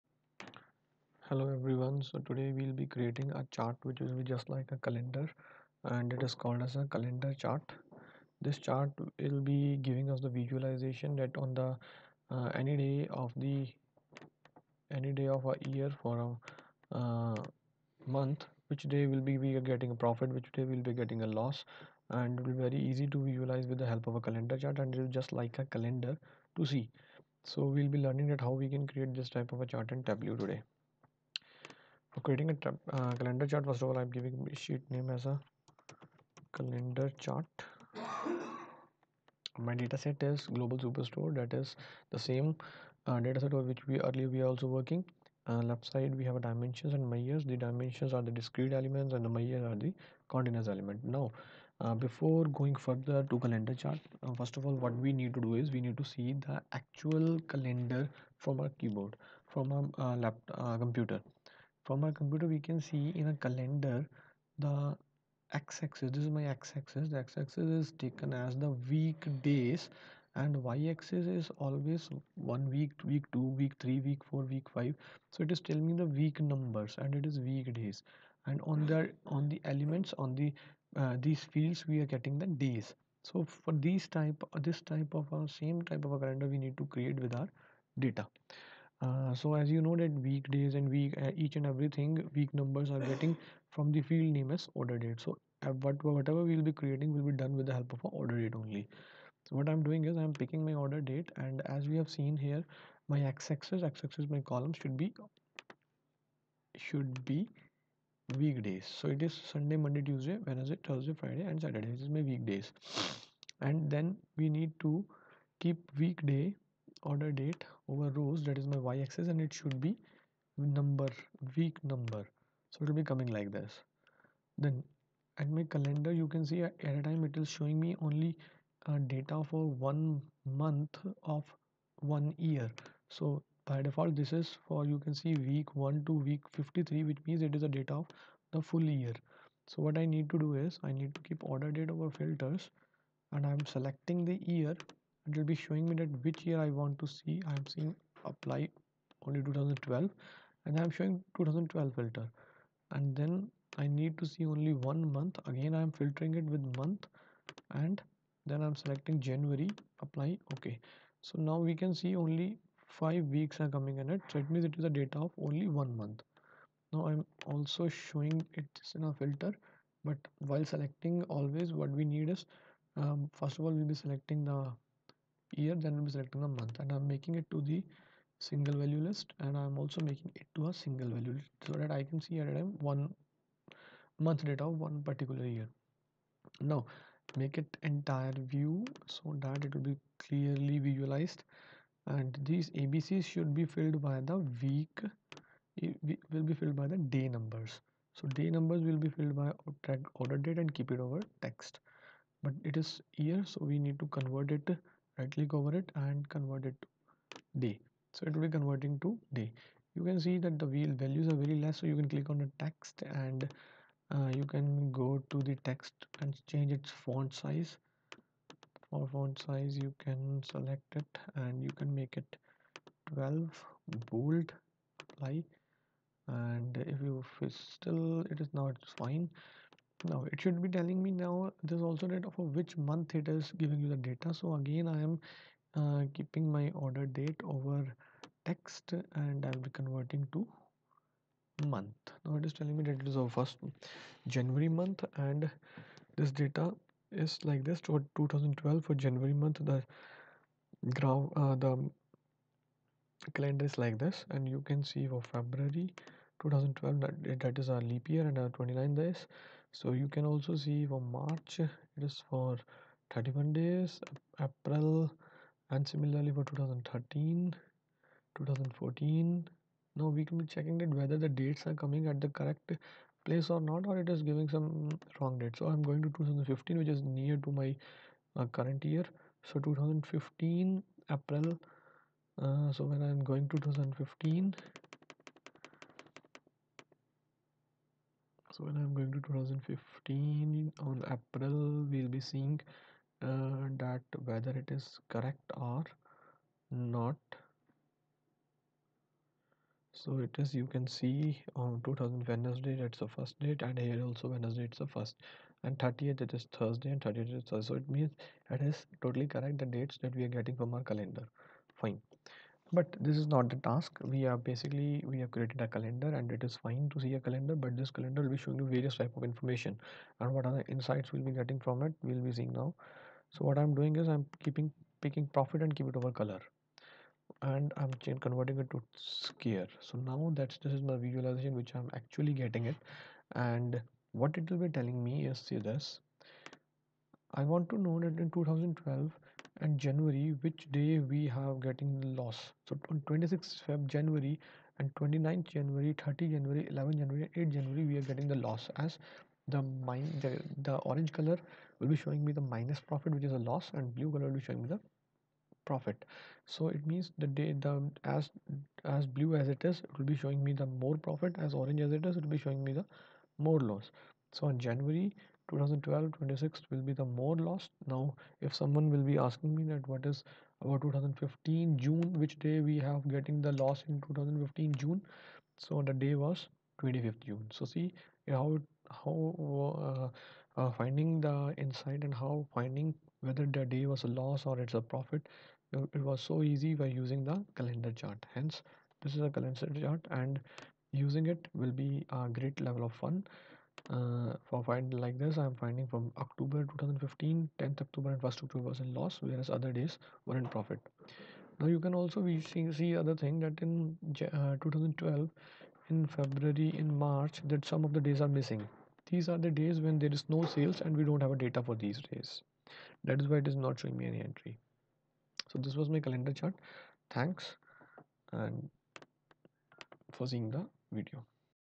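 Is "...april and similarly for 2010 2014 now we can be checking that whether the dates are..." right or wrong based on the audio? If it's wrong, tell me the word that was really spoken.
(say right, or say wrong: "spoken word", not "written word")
wrong: "2013", not "2010".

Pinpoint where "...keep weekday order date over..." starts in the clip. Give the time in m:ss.
1:55.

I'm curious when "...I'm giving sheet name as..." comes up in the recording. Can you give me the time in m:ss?
0:33.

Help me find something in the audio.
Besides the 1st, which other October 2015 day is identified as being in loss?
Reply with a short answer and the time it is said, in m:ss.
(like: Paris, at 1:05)
10th, at 6:37.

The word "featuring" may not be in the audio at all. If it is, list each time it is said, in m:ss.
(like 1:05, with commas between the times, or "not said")
not said.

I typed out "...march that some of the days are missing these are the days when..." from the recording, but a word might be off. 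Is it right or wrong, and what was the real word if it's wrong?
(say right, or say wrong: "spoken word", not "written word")
right.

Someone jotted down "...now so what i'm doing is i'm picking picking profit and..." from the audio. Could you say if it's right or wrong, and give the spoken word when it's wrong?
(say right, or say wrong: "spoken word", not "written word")
wrong: "keeping", not "picking".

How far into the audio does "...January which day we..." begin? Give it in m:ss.
5:39.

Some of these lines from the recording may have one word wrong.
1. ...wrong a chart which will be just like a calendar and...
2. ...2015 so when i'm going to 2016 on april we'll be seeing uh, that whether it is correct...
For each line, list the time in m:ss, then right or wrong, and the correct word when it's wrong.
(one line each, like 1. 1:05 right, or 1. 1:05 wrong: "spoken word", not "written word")
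1. 0:02 wrong: "creating", not "wrong"
2. 4:43 wrong: "2015", not "2016".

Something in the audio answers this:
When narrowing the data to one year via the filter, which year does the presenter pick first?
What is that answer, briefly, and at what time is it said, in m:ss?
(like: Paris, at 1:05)
2012, at 2:28.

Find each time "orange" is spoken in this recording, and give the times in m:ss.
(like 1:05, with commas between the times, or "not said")
5:50, 6:01.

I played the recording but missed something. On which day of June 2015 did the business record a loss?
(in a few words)
25th.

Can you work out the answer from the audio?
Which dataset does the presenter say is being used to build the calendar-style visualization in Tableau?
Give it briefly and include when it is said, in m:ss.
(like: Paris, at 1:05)
Global Superstore, at 0:40.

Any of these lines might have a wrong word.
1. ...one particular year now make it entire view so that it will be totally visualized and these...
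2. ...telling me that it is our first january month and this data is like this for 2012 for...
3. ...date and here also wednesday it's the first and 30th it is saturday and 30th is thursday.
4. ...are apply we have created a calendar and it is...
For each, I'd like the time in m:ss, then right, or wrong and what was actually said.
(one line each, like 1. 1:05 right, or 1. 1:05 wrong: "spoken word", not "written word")
1. 3:04 wrong: "clearly", not "totally"
2. 4:02 right
3. 5:03 wrong: "thursday", not "saturday"
4. 5:14 wrong: "basically", not "apply".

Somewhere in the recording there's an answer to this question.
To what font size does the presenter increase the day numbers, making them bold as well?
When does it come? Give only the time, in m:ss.
3:41.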